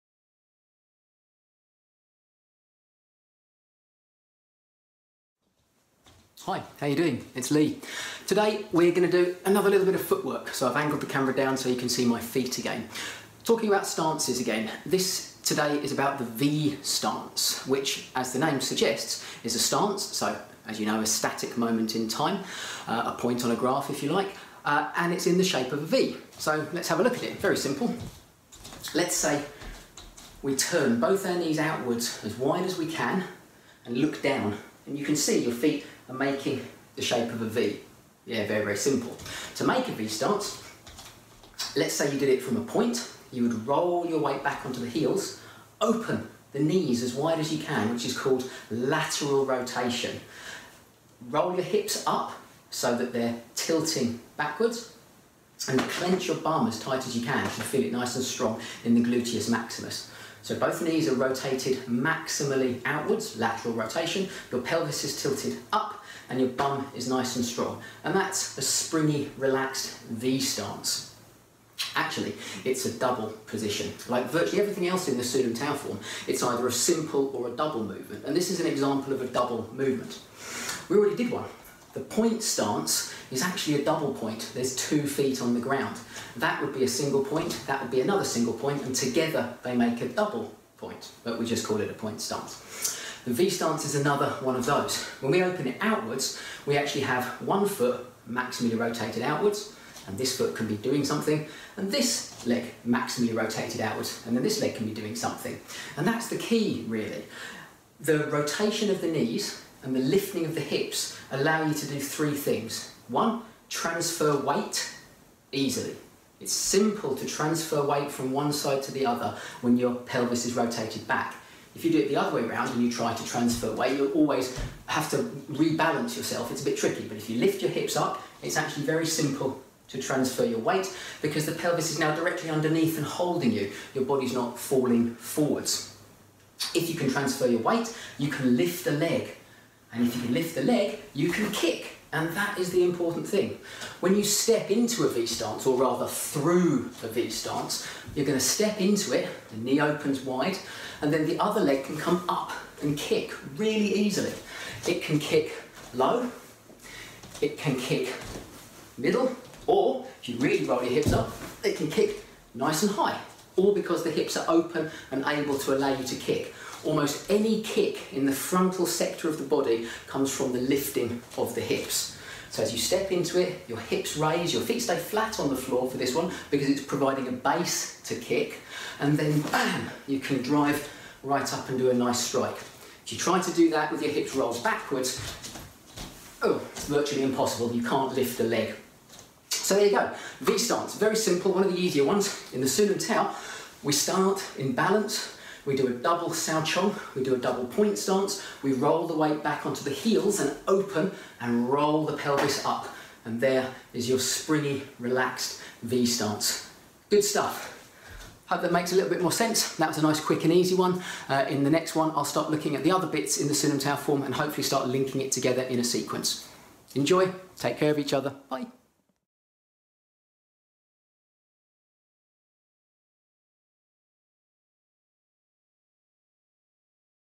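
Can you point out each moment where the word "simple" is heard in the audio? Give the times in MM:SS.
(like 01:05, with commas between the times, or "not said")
00:27, 00:38, 01:16, 01:56, 02:09, 03:11.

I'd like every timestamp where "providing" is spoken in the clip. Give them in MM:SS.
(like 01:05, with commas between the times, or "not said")
02:56.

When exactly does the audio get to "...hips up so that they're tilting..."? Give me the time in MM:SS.
00:51.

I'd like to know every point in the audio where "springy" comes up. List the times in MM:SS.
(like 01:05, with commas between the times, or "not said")
01:08, 03:24.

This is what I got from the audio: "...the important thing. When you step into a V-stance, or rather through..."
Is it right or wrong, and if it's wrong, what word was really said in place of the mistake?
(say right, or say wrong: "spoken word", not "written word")
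right.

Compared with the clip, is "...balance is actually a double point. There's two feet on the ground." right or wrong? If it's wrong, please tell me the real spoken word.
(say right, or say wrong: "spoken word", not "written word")
wrong: "stance", not "balance".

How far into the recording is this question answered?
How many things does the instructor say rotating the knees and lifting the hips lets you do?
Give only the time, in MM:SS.
01:51.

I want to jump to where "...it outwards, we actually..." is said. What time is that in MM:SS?
01:35.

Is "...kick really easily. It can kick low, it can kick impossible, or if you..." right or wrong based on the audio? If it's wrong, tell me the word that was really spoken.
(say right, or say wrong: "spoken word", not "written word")
wrong: "middle", not "impossible".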